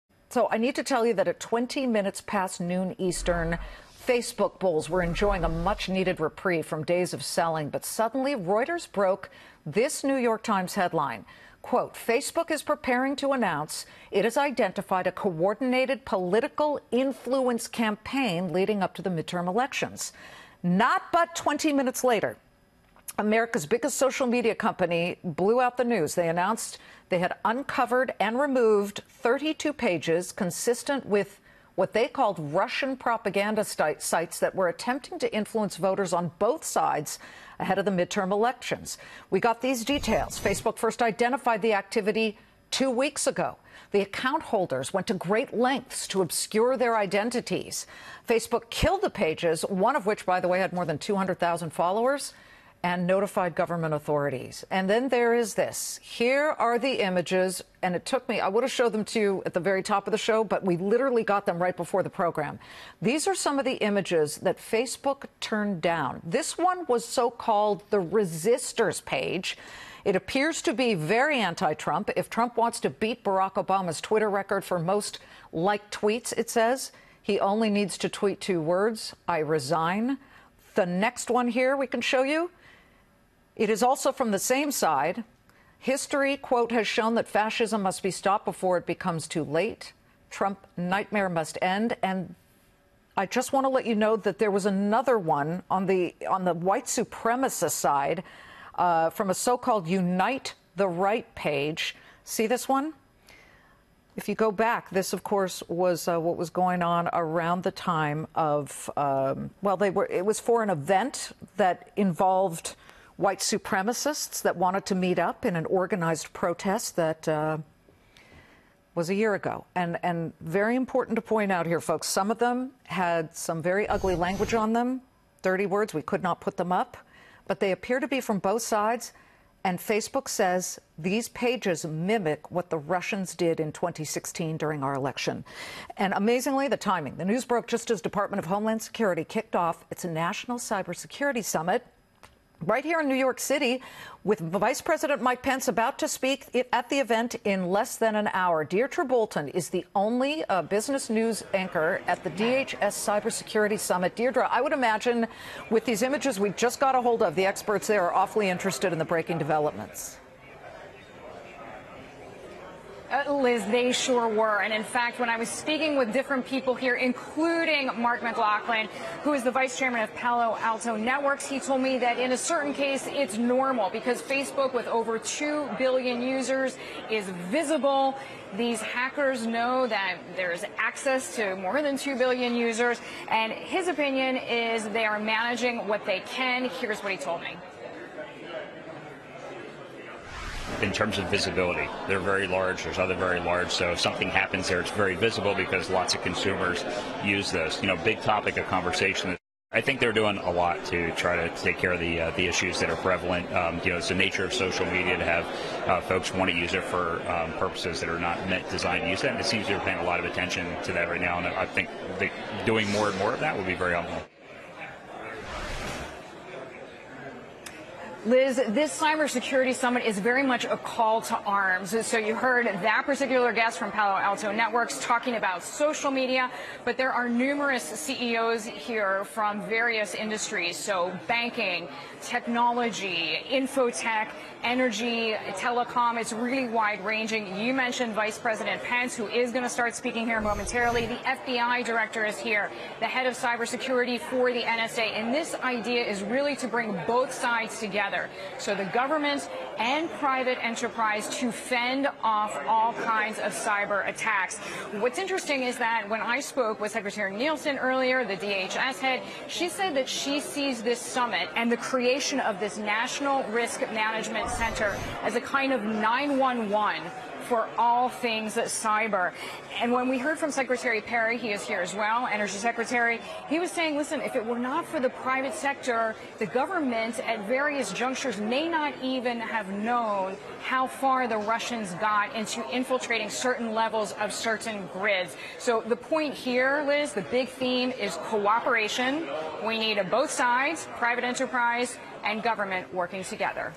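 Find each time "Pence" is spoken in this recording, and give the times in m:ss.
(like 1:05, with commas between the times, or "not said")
2:25, 3:58.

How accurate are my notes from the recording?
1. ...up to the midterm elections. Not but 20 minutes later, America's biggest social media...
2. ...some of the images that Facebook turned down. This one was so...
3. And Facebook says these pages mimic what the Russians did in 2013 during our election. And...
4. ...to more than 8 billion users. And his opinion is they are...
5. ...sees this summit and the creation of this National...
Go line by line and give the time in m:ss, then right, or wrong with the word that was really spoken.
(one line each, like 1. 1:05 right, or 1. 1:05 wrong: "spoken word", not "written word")
1. 0:18 right
2. 1:03 right
3. 2:09 wrong: "2016", not "2013"
4. 3:01 wrong: "2", not "8"
5. 4:20 right.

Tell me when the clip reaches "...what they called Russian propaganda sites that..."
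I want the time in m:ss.
0:31.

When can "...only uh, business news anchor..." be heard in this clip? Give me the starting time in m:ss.
2:29.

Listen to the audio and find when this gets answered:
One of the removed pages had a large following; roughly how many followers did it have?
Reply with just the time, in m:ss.
0:50.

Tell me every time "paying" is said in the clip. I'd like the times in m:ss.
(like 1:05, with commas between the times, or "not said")
3:29.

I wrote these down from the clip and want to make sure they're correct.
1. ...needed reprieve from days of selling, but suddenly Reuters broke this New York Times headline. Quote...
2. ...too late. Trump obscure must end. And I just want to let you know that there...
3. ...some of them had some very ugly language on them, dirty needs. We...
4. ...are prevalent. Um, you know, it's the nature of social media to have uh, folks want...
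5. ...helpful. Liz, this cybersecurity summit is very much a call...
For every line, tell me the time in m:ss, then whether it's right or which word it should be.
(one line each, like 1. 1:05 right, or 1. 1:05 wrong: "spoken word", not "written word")
1. 0:05 right
2. 1:29 wrong: "nightmare", not "obscure"
3. 2:02 wrong: "words", not "needs"
4. 3:22 right
5. 3:33 right.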